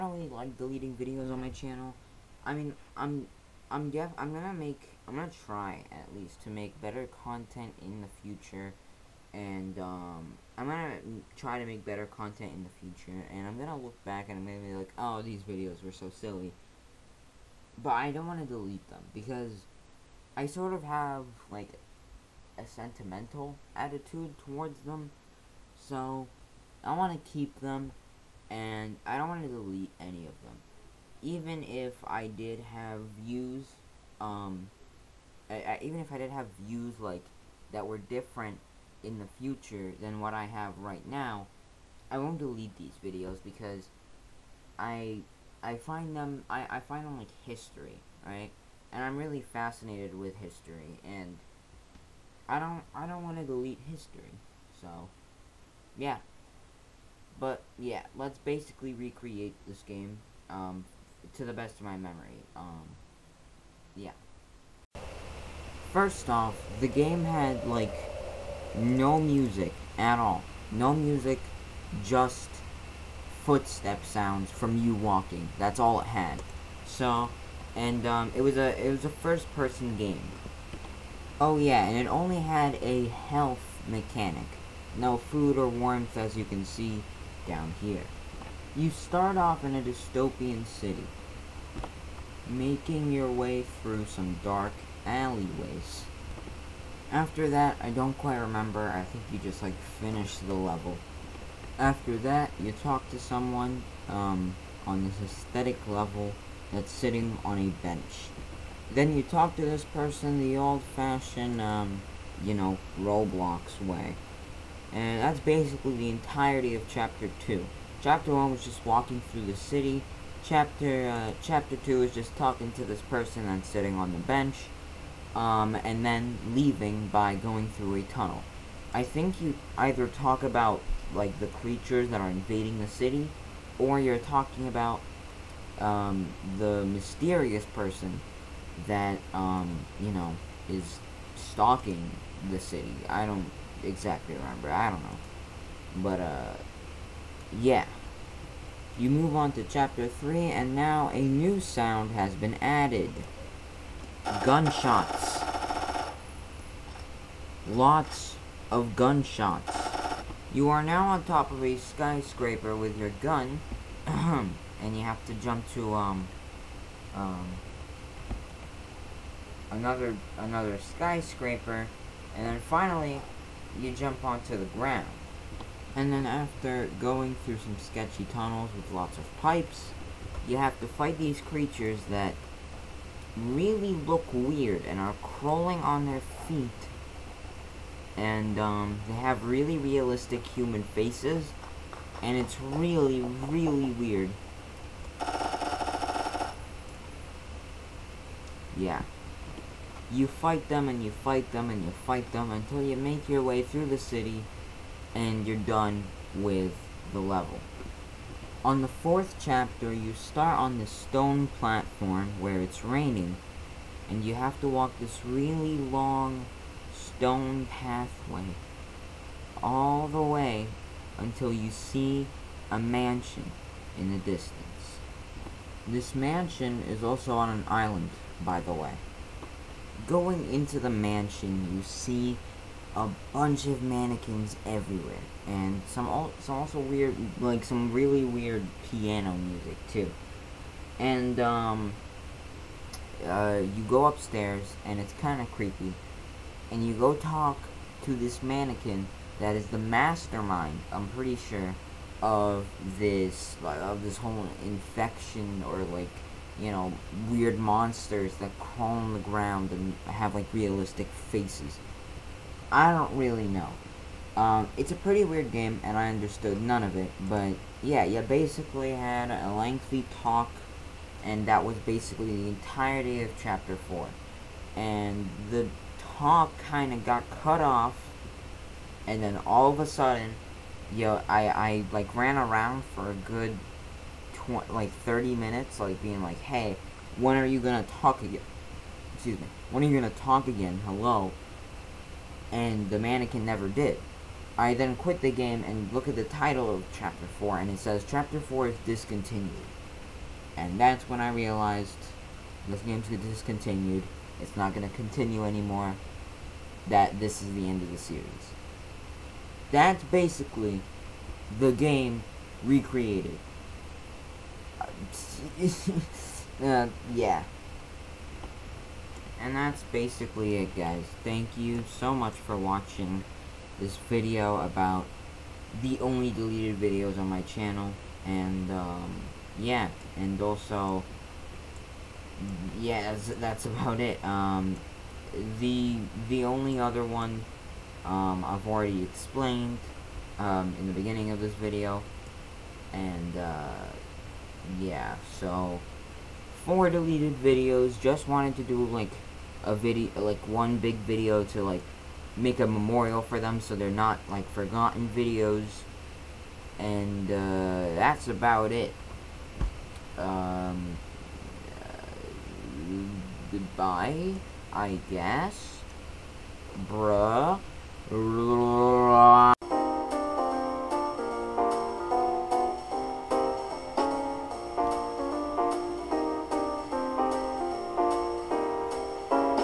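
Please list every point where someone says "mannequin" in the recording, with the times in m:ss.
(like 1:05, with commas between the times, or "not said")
3:53, 4:08, 4:52.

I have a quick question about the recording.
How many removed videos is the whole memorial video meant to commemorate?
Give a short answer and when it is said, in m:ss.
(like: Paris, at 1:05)
4, at 5:46.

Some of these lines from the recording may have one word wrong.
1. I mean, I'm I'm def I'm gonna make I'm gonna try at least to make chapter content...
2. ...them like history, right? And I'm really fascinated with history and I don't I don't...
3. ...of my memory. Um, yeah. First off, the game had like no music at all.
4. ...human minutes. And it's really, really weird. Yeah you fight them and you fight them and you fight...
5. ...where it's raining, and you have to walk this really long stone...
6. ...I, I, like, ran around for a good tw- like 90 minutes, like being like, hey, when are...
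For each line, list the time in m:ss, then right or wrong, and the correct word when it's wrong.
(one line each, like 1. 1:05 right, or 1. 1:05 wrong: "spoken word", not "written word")
1. 0:02 wrong: "better", not "chapter"
2. 0:47 right
3. 1:01 right
4. 3:10 wrong: "faces", not "minutes"
5. 3:32 right
6. 4:41 wrong: "30", not "90".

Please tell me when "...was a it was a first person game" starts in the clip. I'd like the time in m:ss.
1:18.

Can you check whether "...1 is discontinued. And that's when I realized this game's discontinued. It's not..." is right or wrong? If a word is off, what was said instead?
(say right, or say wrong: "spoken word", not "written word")
wrong: "4", not "1".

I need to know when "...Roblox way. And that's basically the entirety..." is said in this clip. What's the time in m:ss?
1:52.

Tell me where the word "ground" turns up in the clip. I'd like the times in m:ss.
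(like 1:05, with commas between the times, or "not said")
2:54, 4:19.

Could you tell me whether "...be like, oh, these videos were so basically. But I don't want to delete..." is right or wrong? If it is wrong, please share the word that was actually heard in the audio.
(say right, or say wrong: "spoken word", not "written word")
wrong: "silly", not "basically".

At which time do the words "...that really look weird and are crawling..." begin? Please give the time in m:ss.
3:02.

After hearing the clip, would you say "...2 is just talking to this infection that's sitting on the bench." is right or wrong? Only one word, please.
wrong.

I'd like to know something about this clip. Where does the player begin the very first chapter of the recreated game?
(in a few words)
A dystopian city.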